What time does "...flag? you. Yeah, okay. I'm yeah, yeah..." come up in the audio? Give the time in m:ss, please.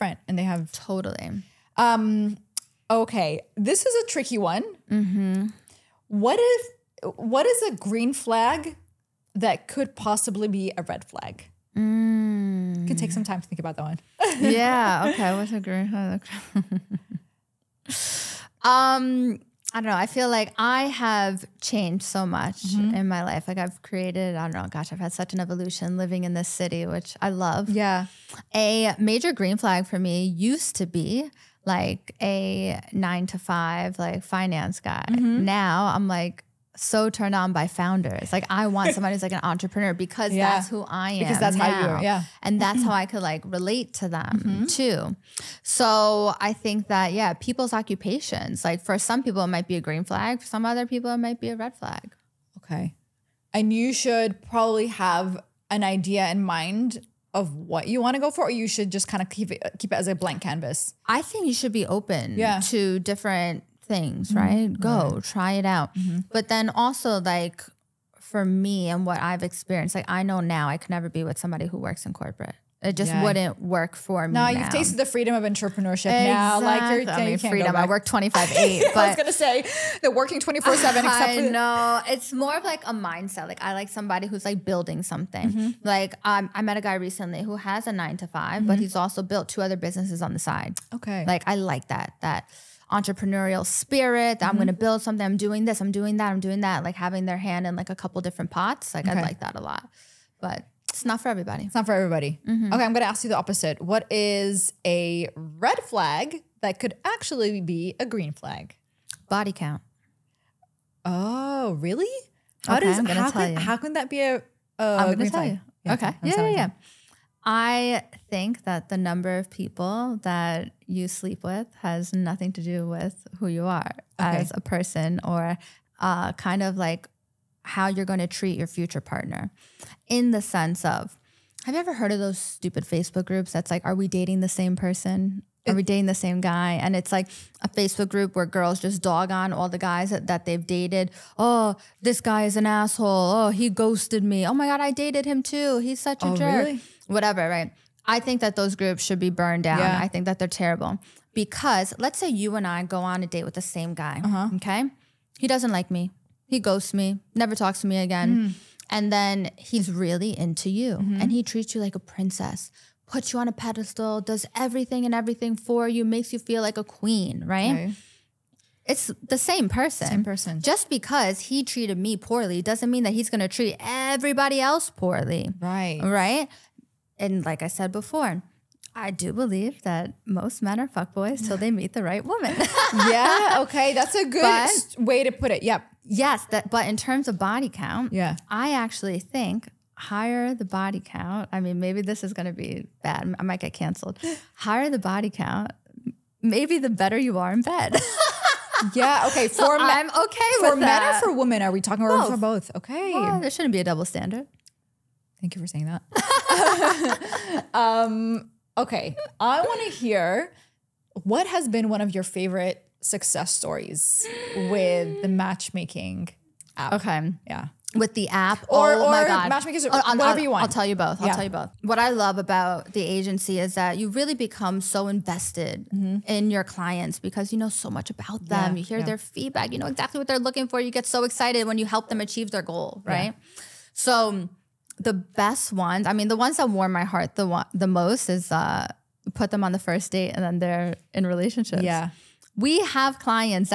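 1:55.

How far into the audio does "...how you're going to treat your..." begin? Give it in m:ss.
2:07.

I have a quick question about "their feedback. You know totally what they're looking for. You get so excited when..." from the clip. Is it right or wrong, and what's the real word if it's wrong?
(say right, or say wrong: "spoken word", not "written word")
wrong: "exactly", not "totally".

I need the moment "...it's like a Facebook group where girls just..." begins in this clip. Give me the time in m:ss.
2:16.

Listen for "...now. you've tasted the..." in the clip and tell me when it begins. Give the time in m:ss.
1:14.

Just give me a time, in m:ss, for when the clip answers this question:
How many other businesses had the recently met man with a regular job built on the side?
1:29.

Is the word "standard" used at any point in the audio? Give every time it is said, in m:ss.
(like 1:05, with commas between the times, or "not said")
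3:24.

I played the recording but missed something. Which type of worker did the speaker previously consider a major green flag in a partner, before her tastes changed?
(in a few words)
Finance guy.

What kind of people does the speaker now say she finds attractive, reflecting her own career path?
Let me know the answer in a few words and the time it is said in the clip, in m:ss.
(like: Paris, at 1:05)
Founders, at 0:37.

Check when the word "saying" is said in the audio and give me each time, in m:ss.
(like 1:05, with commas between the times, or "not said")
3:25.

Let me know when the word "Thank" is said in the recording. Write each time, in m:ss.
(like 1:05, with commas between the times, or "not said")
3:25.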